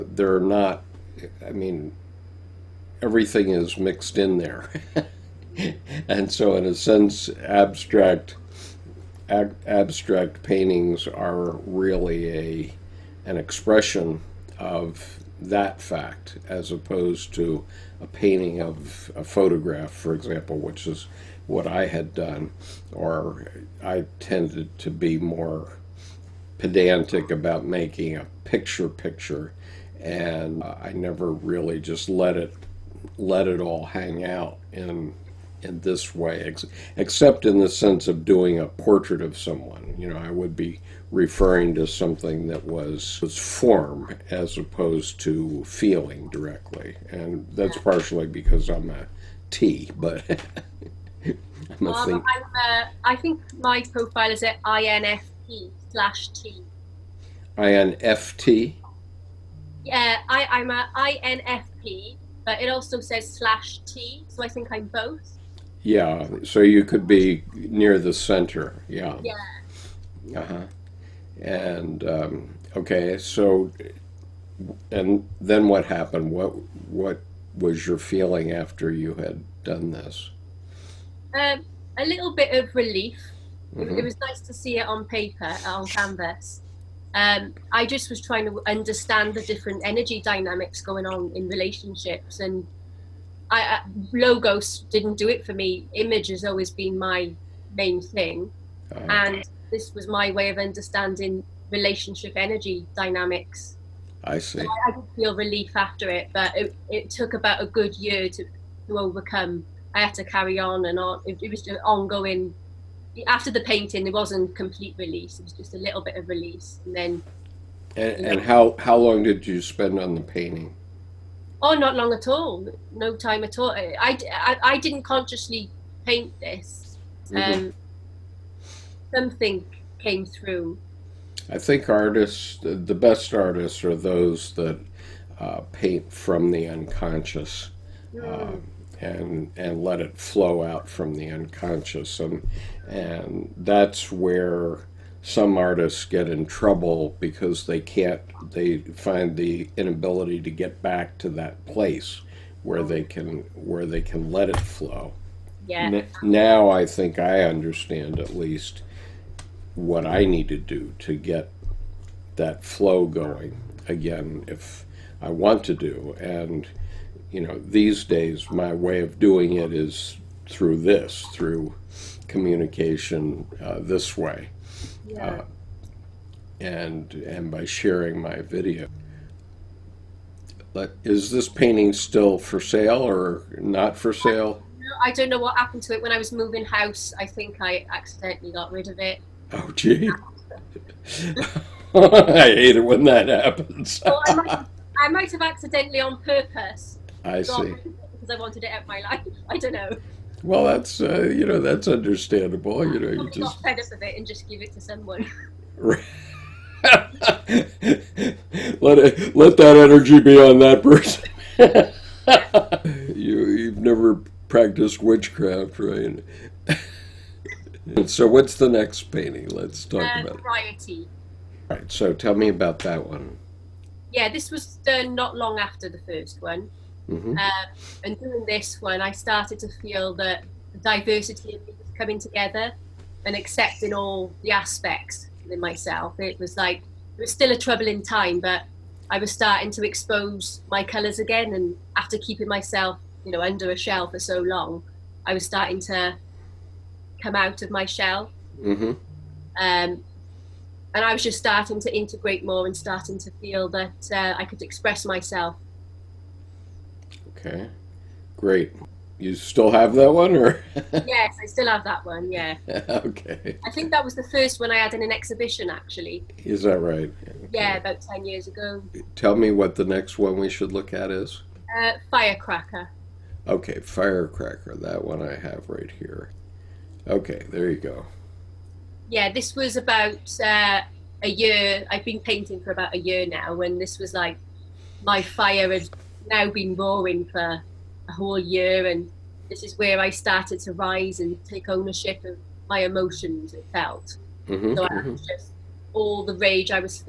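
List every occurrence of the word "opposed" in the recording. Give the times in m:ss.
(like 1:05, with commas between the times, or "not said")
0:16, 0:44.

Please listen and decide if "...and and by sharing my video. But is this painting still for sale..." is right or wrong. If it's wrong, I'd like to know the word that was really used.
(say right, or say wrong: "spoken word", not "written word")
right.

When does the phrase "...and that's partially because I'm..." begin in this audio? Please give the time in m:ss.
0:47.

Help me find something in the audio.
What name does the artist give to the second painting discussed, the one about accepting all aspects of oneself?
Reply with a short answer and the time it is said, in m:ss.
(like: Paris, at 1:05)
Variety, at 3:40.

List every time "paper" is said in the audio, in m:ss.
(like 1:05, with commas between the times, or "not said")
1:25.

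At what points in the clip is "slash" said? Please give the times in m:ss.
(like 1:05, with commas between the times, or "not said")
0:55, 1:03.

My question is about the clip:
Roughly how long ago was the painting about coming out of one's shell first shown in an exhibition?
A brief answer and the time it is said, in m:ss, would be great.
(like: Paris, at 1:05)
10 years ago, at 4:28.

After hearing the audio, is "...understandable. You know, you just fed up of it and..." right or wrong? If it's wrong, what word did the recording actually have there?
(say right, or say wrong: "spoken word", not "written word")
right.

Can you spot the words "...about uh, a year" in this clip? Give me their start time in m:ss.
4:39.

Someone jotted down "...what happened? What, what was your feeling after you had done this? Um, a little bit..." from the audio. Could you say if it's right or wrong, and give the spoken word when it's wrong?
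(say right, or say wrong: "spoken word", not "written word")
right.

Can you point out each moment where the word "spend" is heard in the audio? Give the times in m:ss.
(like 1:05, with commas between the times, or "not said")
1:59.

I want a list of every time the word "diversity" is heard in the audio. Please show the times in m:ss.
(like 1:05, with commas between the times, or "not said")
3:50.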